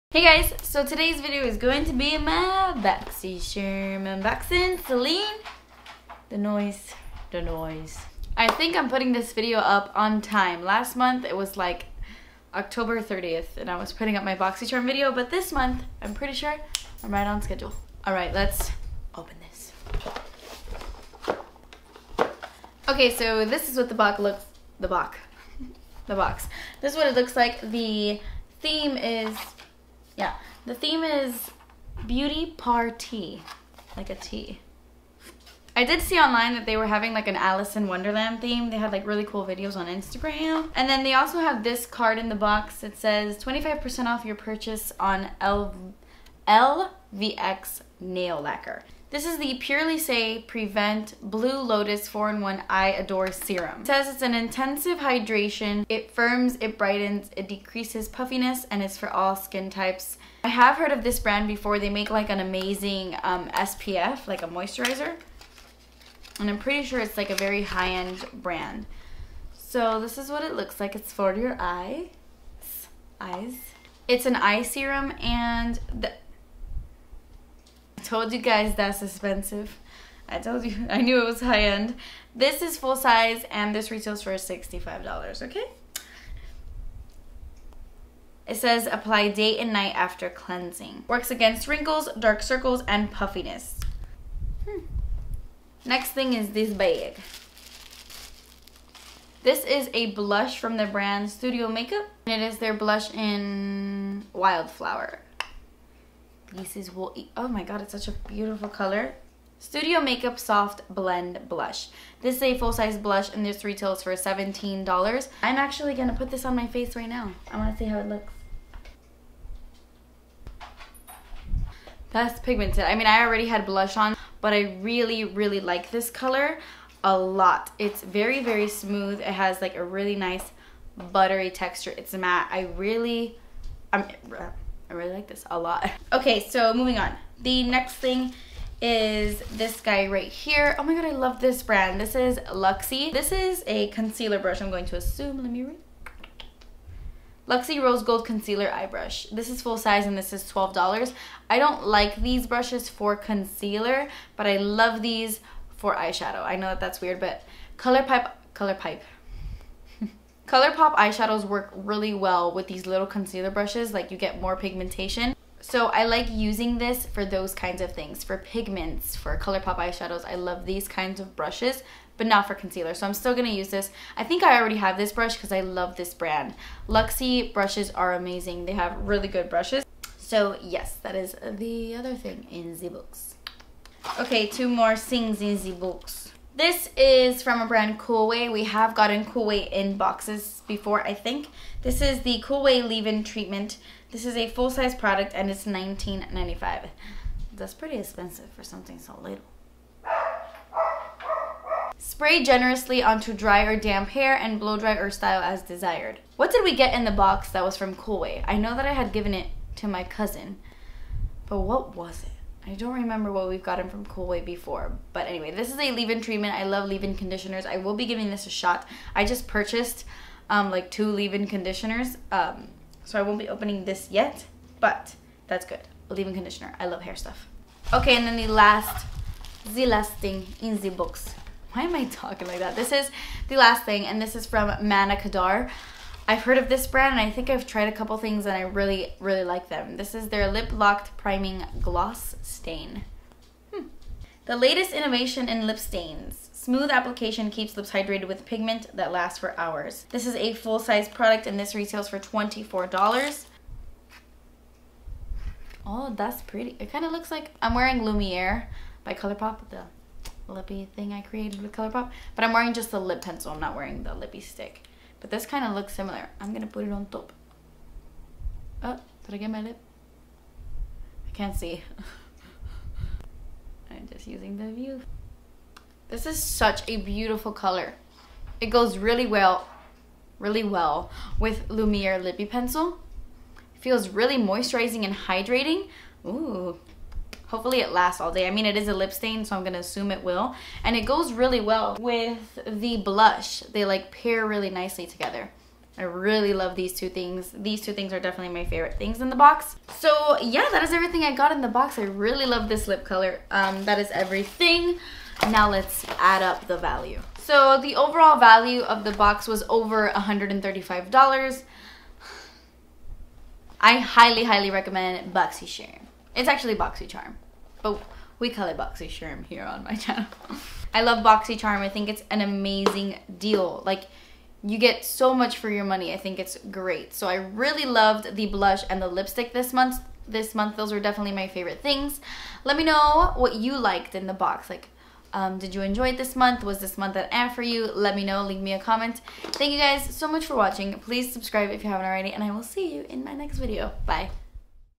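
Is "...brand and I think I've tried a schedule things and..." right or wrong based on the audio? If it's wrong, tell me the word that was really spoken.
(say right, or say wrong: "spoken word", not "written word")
wrong: "couple", not "schedule".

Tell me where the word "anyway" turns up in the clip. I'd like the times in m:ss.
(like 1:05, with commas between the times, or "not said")
3:35.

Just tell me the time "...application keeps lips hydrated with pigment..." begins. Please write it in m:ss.
4:06.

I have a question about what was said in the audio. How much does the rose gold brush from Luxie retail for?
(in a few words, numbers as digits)
$12.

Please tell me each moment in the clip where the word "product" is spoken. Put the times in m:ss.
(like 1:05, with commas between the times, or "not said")
3:14, 4:11.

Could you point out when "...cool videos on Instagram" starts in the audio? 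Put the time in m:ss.
0:39.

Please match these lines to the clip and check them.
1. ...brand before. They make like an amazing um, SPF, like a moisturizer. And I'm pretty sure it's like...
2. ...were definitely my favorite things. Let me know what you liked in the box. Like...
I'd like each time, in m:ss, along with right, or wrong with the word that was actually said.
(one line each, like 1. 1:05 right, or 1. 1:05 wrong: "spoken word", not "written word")
1. 1:01 right
2. 5:30 right.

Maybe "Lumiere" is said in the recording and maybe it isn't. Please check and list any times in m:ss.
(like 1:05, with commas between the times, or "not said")
4:18, 4:41.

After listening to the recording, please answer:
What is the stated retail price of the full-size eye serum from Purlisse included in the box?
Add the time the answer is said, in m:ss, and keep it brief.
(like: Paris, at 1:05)
$65, at 1:24.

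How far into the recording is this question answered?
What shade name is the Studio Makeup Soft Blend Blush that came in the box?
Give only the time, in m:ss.
1:44.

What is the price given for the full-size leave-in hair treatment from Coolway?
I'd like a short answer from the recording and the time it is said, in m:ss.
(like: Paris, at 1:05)
$19.95, at 3:15.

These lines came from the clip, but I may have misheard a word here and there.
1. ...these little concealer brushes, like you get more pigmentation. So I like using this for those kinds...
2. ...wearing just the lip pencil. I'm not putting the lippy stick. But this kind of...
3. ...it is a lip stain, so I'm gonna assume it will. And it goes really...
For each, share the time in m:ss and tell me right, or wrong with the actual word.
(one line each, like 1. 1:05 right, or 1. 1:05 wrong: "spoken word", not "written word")
1. 2:42 right
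2. 4:22 wrong: "wearing", not "putting"
3. 4:48 right.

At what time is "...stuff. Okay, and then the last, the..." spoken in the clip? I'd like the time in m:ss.
3:47.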